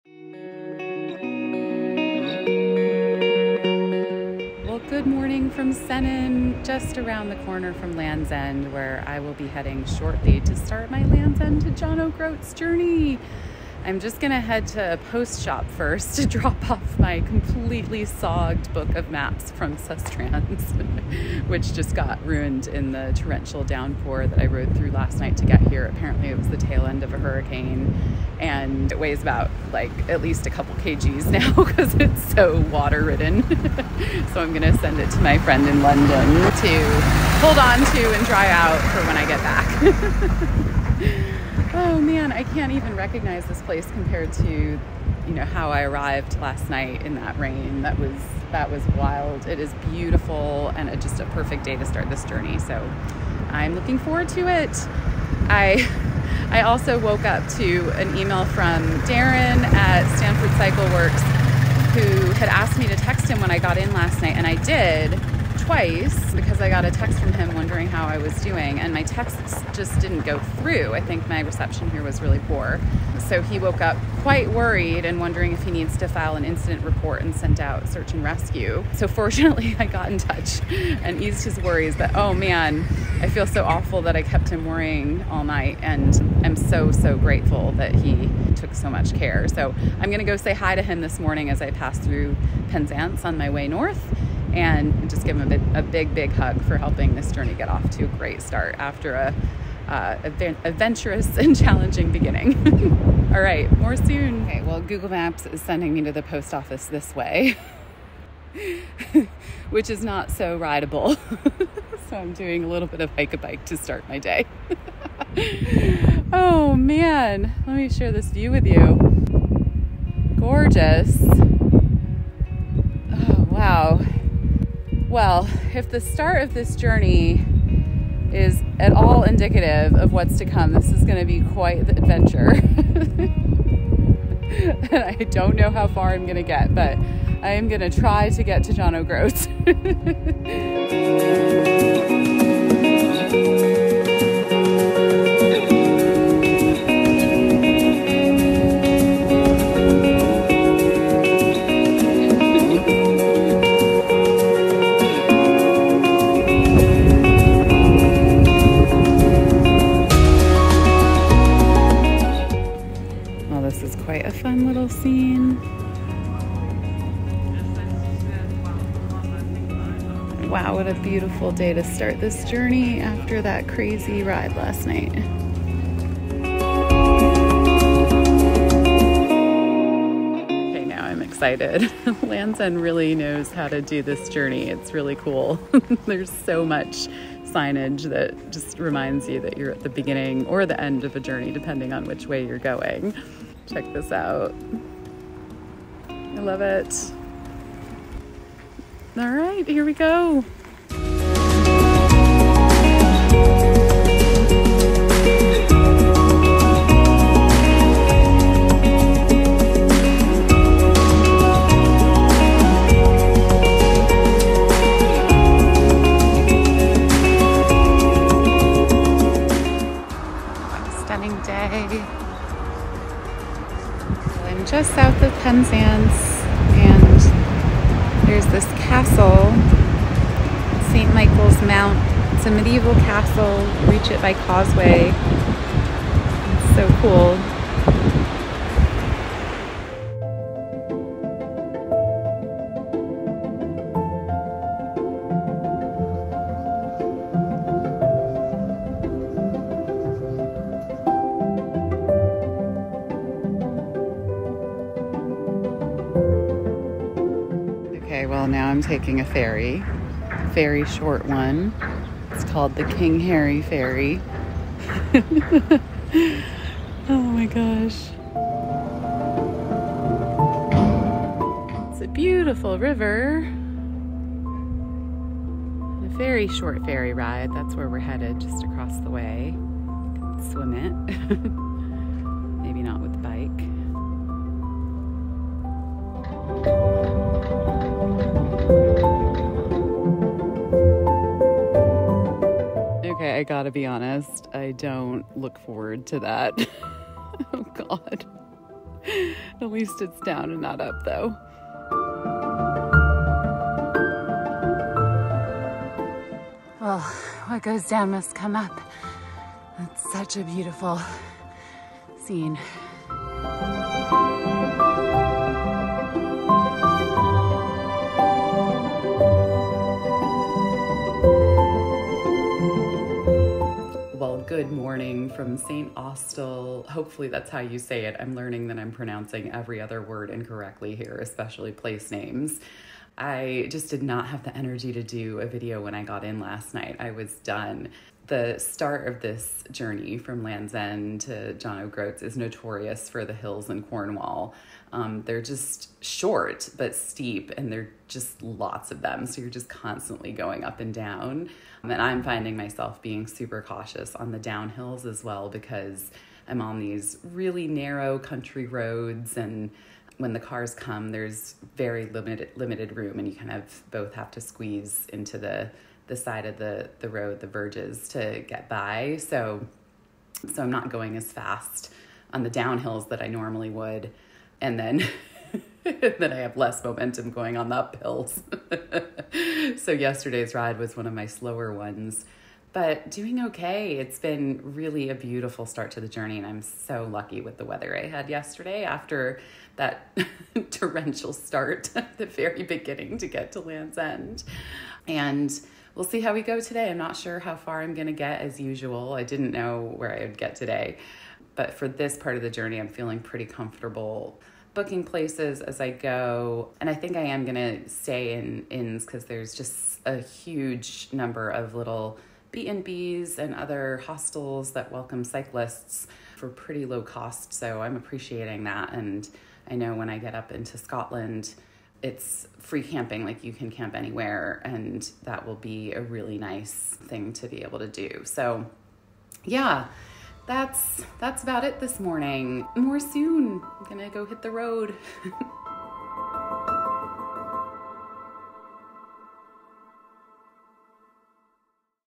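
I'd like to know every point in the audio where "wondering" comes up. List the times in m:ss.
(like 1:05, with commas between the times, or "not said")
1:07, 1:15.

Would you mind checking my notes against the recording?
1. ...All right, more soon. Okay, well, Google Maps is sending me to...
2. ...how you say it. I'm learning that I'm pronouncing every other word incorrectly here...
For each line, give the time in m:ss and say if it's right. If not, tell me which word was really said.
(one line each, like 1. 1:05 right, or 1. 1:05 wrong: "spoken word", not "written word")
1. 1:43 right
2. 5:27 right.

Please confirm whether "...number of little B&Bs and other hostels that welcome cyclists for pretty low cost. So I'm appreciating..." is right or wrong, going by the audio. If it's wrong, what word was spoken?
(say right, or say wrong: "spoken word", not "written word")
right.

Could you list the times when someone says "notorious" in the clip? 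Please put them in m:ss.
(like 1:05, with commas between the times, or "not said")
5:42.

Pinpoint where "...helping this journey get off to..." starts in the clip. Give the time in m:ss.
1:36.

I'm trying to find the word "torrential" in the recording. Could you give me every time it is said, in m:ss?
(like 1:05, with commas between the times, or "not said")
0:23, 6:30.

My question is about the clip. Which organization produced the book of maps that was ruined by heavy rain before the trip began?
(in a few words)
Sustrans.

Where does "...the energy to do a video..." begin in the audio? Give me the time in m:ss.
5:34.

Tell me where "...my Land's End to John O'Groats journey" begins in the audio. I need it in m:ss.
0:10.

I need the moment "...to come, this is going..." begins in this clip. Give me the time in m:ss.
2:10.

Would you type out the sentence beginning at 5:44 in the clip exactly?
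Um, they're just short but steep, and they're just lots of them.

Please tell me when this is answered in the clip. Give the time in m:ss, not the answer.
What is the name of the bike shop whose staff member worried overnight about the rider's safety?
1:00.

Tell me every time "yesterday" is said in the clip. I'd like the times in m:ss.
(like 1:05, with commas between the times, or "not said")
6:19, 6:28.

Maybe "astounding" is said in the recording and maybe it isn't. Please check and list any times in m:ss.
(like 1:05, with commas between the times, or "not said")
not said.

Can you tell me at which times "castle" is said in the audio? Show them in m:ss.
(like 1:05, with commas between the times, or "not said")
3:48, 3:52.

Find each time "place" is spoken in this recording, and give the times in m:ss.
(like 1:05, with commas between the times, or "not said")
0:43, 5:31, 6:45.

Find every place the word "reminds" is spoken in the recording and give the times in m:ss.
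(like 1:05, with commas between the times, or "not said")
3:08.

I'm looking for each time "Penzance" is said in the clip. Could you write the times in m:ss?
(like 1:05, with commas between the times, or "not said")
1:32, 3:45.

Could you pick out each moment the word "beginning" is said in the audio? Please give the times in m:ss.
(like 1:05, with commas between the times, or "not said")
1:42, 3:09, 6:32.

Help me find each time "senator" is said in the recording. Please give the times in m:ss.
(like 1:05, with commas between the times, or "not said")
not said.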